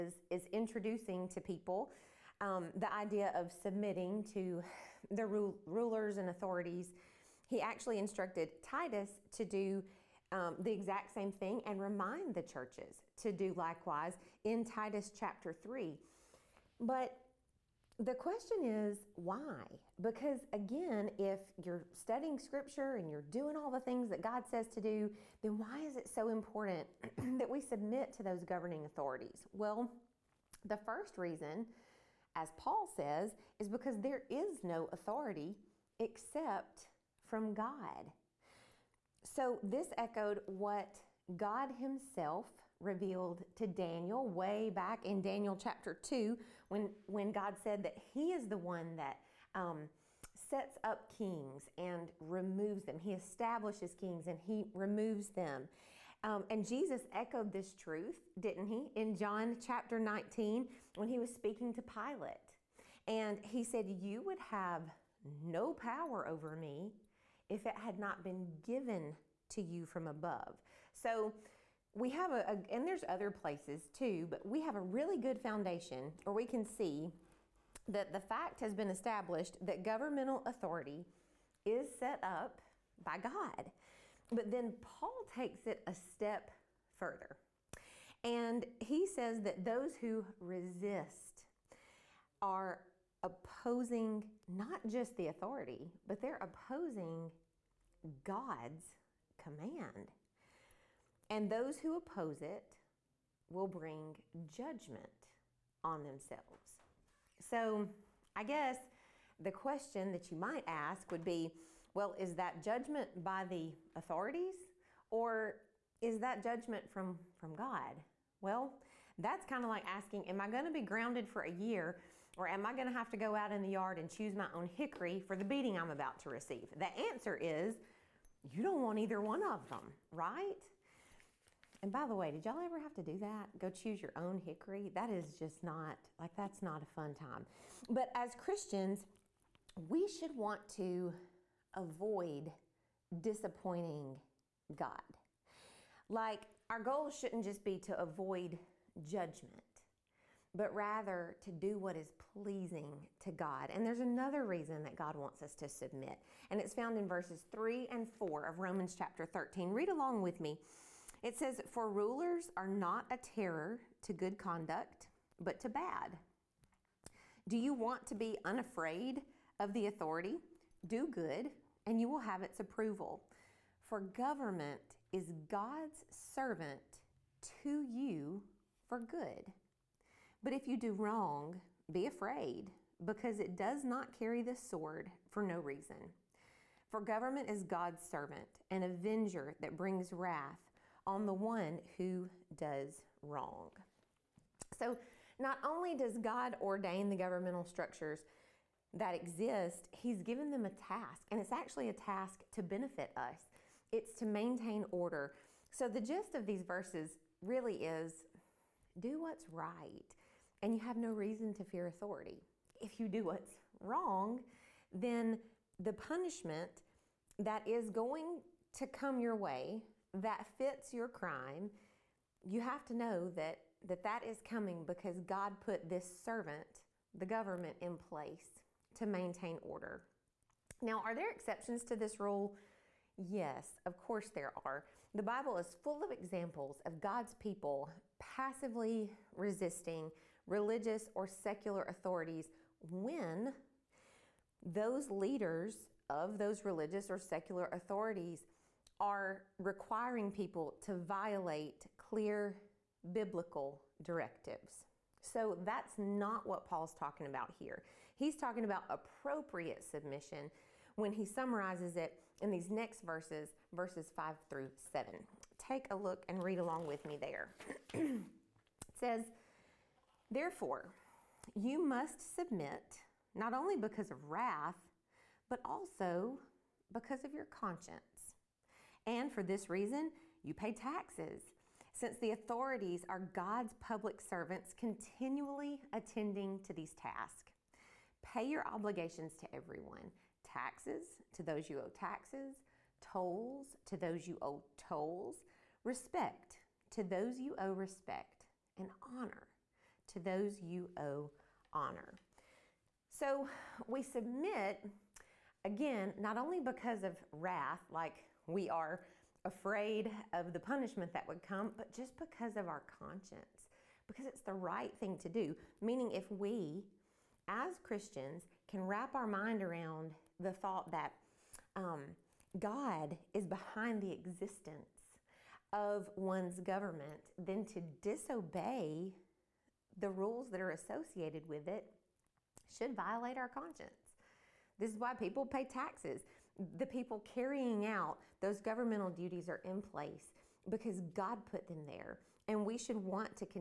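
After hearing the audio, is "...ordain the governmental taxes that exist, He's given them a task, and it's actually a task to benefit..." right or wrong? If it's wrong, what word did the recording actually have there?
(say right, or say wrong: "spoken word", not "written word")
wrong: "structures", not "taxes".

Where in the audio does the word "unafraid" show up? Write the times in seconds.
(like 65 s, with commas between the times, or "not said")
168 s.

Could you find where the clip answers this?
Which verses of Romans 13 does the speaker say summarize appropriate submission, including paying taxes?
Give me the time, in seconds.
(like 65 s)
263 s.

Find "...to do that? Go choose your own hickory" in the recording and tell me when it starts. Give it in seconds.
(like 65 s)
132 s.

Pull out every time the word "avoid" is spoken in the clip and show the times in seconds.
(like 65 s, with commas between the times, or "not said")
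141 s, 147 s.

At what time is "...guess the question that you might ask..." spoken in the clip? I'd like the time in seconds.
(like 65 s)
108 s.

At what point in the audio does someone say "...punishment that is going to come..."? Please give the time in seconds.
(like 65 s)
215 s.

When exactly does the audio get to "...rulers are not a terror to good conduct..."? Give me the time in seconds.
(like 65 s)
161 s.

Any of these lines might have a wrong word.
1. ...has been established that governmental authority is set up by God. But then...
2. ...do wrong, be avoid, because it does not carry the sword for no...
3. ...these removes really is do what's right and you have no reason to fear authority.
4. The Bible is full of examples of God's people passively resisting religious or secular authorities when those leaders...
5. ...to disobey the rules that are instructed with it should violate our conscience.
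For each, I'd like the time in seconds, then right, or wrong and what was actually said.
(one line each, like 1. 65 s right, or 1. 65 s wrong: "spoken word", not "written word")
1. 78 s right
2. 180 s wrong: "afraid", not "avoid"
3. 206 s wrong: "verses", not "removes"
4. 235 s right
5. 327 s wrong: "associated", not "instructed".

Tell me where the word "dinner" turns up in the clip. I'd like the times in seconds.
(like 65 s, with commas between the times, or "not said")
not said.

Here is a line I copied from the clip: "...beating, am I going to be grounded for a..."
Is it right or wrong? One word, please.
wrong.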